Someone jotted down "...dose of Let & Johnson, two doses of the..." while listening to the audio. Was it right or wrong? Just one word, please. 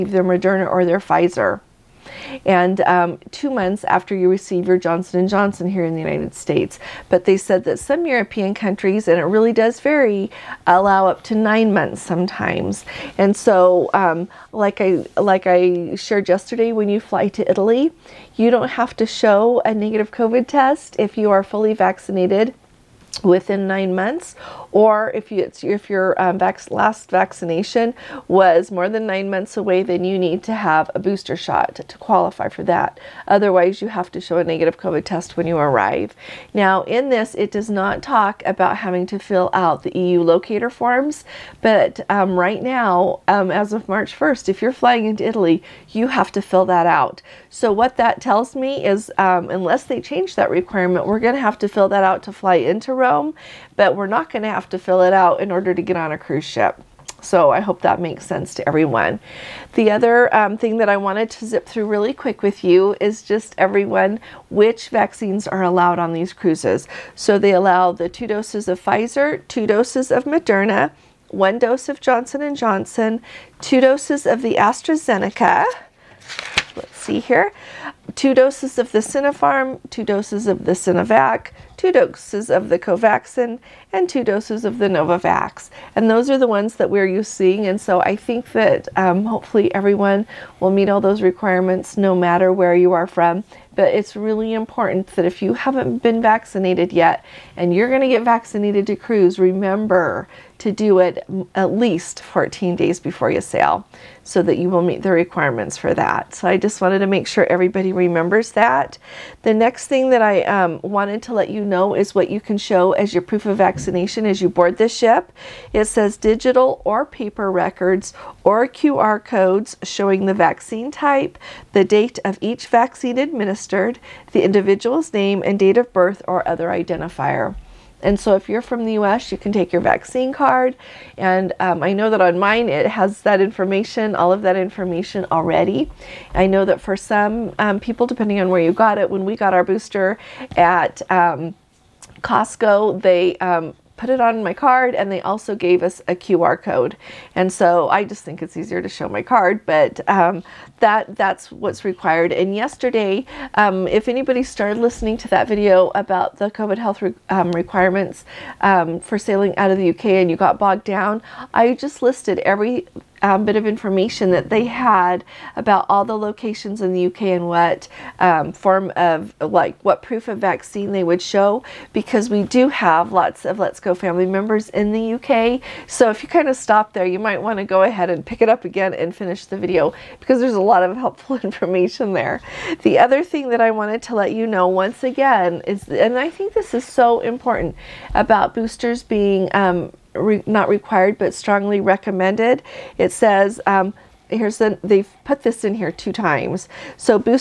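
wrong.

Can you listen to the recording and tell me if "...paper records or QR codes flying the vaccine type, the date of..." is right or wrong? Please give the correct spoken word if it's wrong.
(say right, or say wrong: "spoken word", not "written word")
wrong: "showing", not "flying".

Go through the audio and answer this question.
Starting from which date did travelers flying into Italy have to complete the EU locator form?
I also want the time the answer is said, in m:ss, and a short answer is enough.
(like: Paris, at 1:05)
March 1st, at 0:43.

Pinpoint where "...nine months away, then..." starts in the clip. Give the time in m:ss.
0:29.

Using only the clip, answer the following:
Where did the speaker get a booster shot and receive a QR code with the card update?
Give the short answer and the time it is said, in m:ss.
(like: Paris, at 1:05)
Costco, at 2:22.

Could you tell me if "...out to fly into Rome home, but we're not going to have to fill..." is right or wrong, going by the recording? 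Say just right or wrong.
right.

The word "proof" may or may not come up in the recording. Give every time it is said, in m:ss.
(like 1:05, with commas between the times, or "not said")
1:53, 2:50.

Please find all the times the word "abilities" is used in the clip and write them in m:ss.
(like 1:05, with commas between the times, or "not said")
not said.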